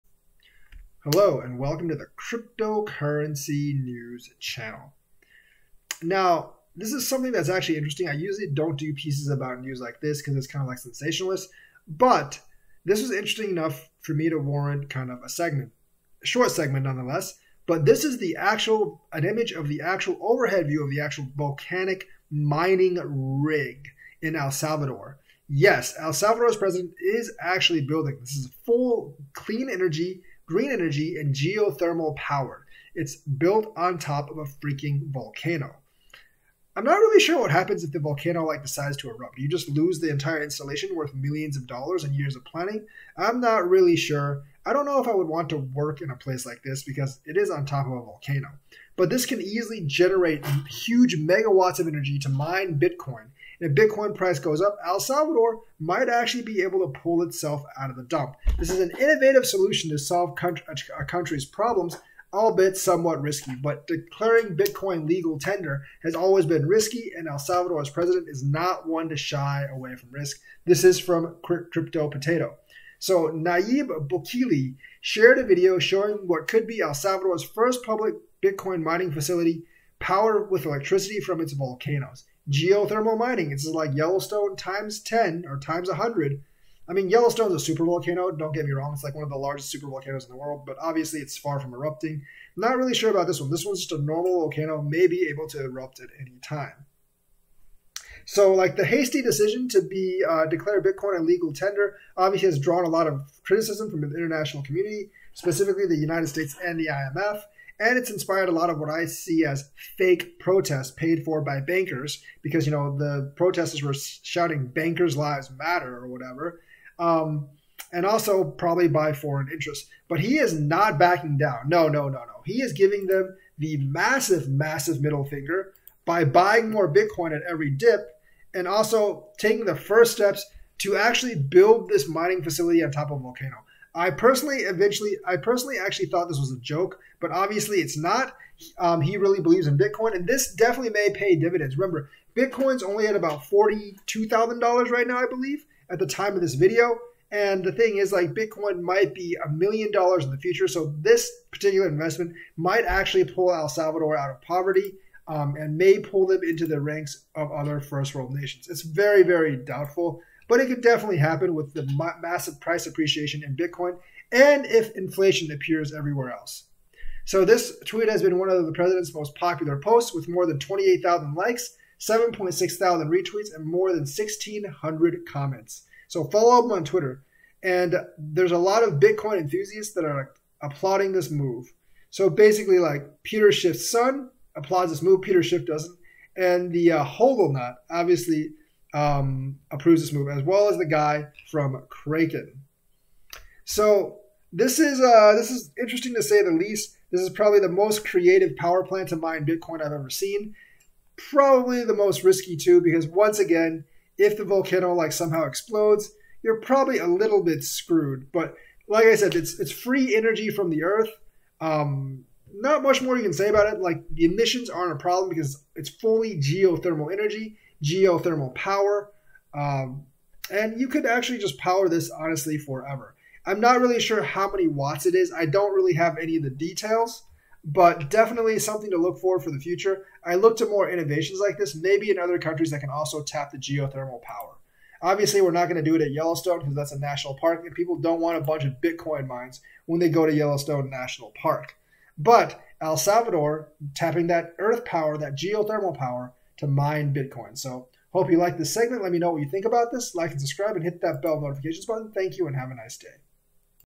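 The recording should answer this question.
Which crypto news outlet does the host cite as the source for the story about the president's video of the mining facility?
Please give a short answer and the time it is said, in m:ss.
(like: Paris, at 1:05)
Crypto Potato, at 1:11.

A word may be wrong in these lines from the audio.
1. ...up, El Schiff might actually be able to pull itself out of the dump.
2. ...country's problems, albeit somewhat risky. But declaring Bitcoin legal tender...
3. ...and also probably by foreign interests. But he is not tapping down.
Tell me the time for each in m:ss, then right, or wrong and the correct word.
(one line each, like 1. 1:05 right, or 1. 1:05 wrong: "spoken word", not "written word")
1. 0:54 wrong: "Salvador", not "Schiff"
2. 1:01 right
3. 1:57 wrong: "backing", not "tapping".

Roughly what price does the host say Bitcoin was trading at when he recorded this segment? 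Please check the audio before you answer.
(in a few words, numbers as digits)
$42,000.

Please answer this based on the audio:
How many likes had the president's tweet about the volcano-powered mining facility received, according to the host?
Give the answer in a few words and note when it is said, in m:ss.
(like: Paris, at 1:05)
28,000, at 2:50.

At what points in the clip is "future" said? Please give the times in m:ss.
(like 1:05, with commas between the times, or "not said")
2:30, 3:49.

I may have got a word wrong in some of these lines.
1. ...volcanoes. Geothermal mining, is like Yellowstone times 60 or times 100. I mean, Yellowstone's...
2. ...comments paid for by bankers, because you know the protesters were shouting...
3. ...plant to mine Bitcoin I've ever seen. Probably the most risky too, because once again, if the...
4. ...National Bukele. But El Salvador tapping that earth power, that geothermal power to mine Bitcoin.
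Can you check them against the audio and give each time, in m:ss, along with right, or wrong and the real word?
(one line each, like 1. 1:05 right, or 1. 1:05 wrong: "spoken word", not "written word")
1. 1:21 wrong: "10", not "60"
2. 1:50 wrong: "protests", not "comments"
3. 3:18 right
4. 4:00 wrong: "Park", not "Bukele".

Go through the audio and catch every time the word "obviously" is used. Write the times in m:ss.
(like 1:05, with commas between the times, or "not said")
1:30, 1:42, 2:17, 3:07, 3:55.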